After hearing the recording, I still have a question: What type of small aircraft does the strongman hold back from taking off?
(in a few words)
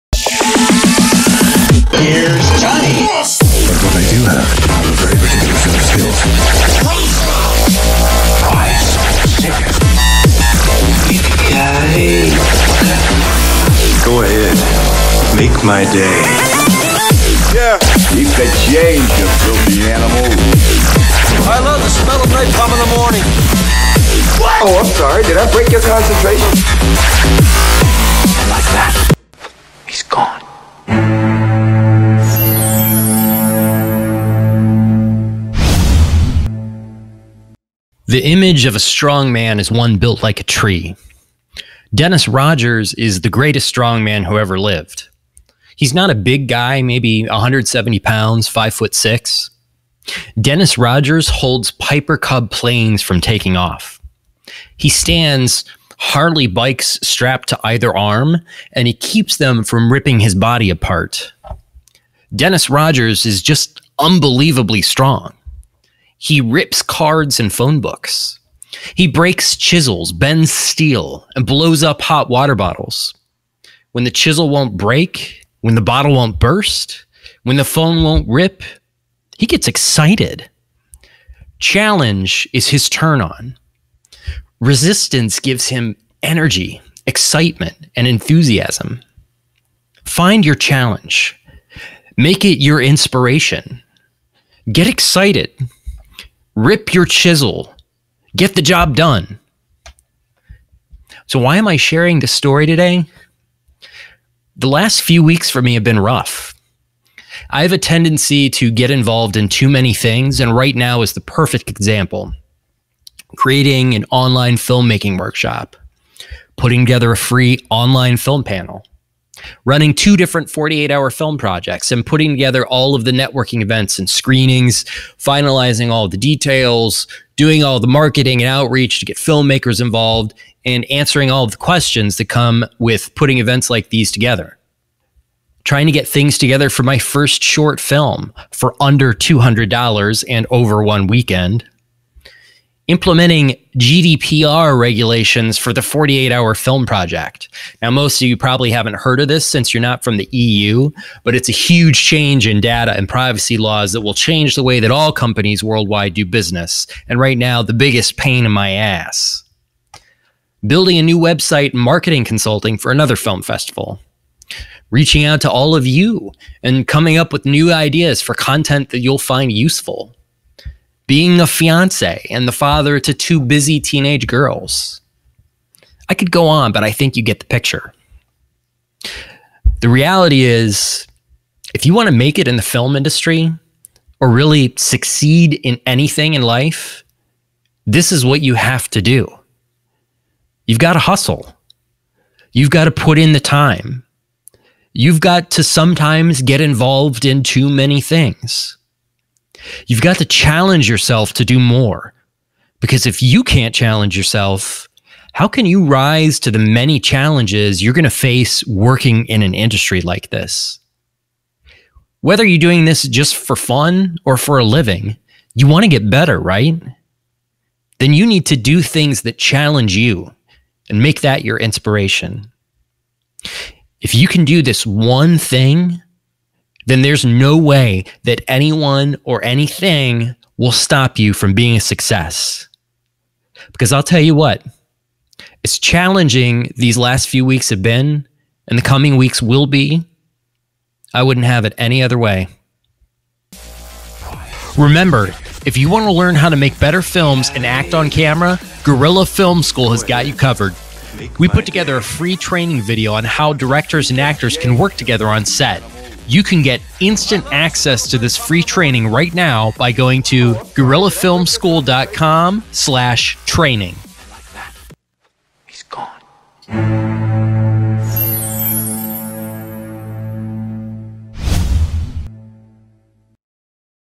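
Piper Cub.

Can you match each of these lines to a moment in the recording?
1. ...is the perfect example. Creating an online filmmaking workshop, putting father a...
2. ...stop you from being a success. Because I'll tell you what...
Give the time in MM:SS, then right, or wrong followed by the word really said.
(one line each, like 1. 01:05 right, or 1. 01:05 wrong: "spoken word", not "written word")
1. 01:51 wrong: "together", not "father"
2. 03:50 right.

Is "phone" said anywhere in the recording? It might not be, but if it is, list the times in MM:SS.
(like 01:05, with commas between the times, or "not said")
01:07, 01:17.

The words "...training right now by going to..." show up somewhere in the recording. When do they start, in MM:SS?
04:18.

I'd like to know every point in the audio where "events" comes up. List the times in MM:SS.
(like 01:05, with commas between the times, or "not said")
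02:03, 02:13.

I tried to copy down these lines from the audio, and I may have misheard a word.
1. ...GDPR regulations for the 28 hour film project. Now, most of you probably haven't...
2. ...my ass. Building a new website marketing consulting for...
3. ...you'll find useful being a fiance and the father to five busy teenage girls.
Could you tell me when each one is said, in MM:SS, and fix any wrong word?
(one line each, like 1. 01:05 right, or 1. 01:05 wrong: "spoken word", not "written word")
1. 02:23 wrong: "48", not "28"
2. 02:38 right
3. 02:48 wrong: "two", not "five".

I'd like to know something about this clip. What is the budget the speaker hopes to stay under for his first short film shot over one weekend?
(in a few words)
$200.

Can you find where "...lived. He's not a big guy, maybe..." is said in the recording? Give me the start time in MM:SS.
00:44.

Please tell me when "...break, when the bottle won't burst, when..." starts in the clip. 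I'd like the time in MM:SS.
01:14.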